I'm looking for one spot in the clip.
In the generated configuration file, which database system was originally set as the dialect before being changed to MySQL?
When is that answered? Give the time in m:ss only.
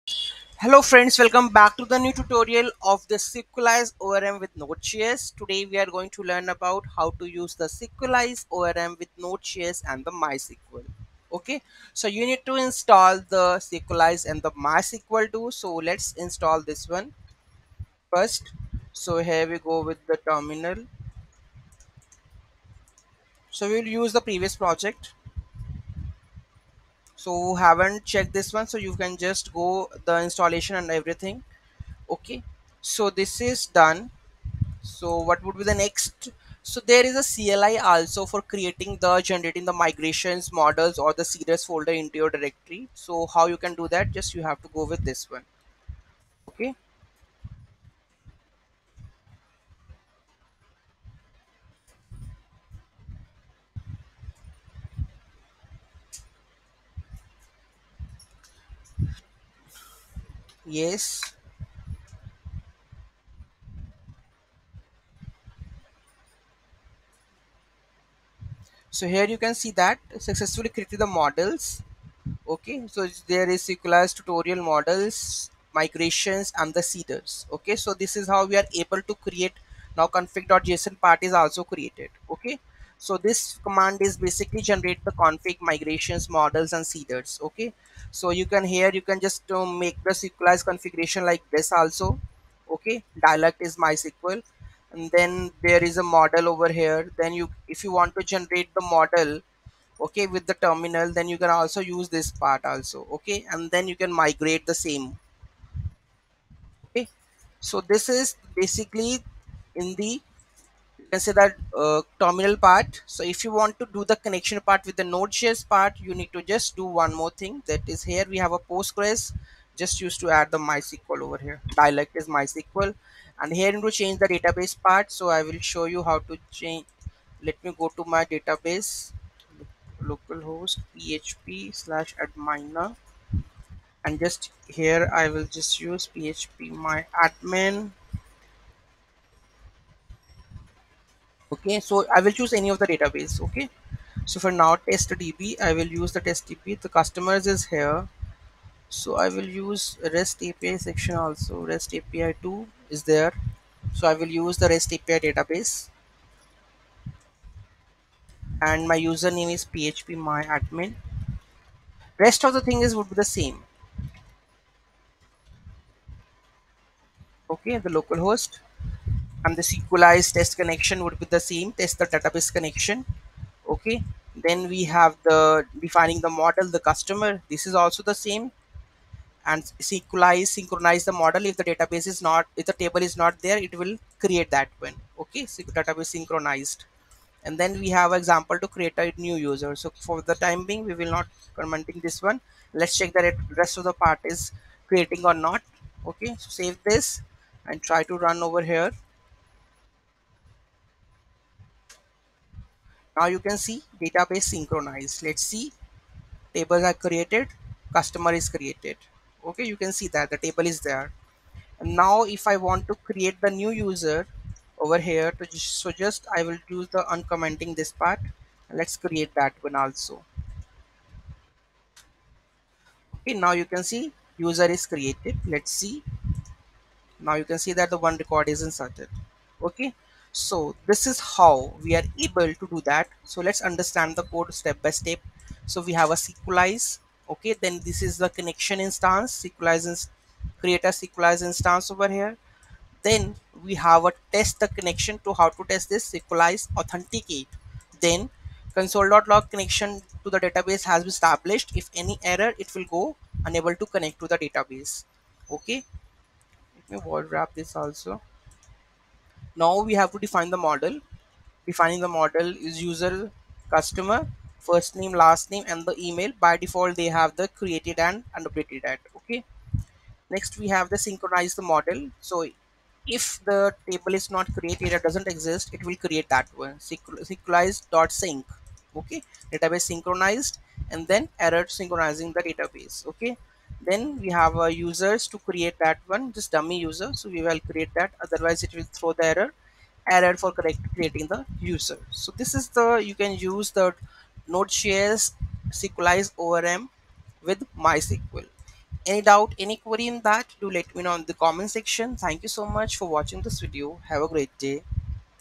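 1:58.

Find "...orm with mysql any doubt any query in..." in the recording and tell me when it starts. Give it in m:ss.
4:56.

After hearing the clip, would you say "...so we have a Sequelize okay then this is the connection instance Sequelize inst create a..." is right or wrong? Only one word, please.
right.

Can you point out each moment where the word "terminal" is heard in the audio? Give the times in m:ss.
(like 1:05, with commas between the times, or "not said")
0:20, 1:40, 1:52.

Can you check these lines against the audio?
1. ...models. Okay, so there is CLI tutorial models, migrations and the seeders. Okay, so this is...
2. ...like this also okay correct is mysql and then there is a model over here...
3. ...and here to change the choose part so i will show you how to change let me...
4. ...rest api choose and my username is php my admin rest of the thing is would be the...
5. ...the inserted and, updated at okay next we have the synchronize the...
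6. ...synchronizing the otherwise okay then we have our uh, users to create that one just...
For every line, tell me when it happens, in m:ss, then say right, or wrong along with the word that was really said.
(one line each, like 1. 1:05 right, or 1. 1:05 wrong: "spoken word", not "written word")
1. 1:11 wrong: "SQLite", not "CLI"
2. 1:31 wrong: "dialect", not "correct"
3. 2:03 wrong: "database", not "choose"
4. 2:34 wrong: "database", not "choose"
5. 4:27 wrong: "created", not "inserted"
6. 4:41 wrong: "database", not "otherwise".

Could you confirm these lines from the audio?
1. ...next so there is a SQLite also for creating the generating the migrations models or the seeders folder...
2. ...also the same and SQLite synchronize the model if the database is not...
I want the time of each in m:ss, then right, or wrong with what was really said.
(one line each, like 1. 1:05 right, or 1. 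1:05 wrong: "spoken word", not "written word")
1. 0:35 wrong: "CLI", not "SQLite"
2. 2:57 wrong: "Sequelize", not "SQLite".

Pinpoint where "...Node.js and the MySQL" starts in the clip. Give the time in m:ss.
0:09.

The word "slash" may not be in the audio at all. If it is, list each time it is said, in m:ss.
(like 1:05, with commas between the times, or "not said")
2:11.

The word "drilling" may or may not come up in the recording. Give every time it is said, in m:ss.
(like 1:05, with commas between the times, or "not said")
not said.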